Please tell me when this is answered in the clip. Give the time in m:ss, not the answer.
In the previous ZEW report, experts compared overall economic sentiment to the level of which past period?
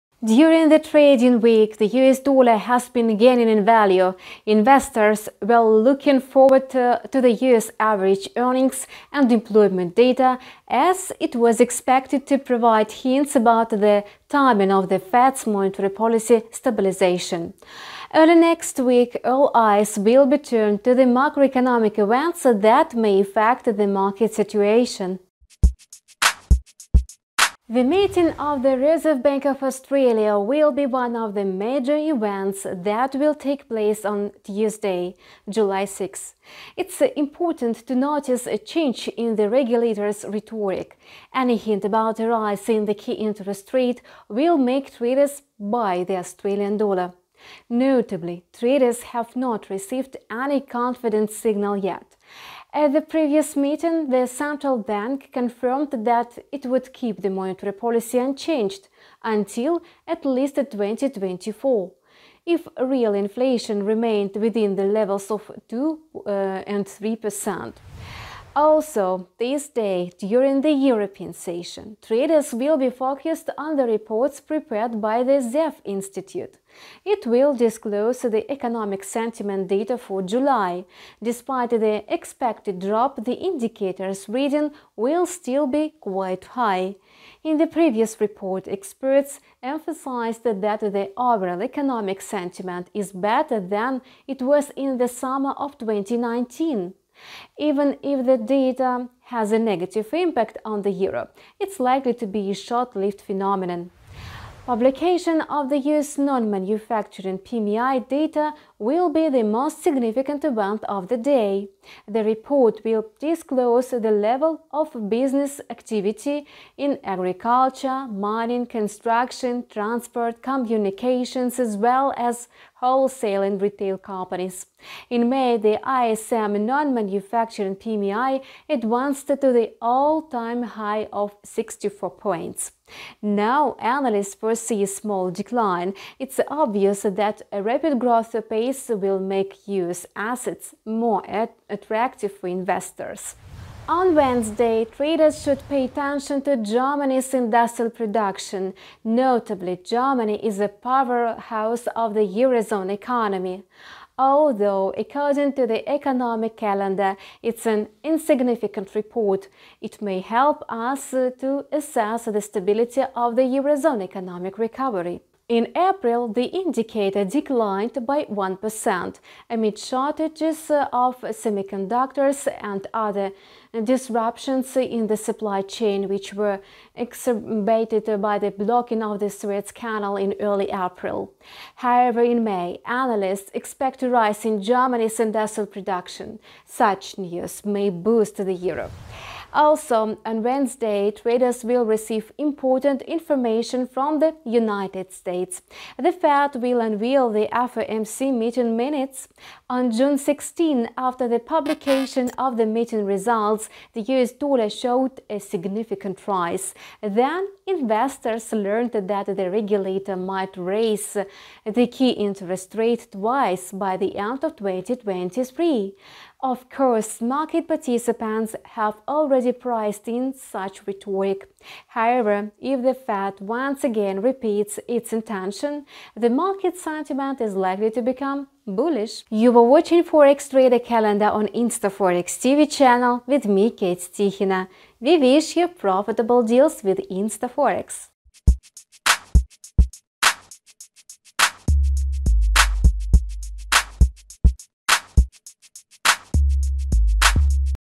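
1:35.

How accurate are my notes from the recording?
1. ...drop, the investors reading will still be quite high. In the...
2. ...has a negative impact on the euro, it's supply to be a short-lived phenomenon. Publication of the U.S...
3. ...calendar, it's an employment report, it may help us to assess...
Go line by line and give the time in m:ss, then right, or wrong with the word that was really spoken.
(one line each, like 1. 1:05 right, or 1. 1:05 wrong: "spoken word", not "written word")
1. 1:22 wrong: "indicators", not "investors"
2. 1:39 wrong: "likely", not "supply"
3. 2:36 wrong: "insignificant", not "employment".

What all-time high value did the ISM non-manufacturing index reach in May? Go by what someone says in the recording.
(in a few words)
64 points.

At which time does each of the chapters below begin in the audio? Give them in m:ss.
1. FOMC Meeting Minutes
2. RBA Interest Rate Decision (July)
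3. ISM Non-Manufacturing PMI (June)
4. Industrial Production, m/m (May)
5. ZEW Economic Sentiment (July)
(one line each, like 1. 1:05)
1. 3:09
2. 0:27
3. 1:44
4. 2:45
5. 1:08.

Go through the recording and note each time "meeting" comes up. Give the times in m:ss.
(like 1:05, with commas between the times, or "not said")
0:27, 0:53, 3:18, 3:22.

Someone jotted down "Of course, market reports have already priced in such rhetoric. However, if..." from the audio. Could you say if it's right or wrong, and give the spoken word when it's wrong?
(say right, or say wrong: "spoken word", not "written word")
wrong: "participants", not "reports".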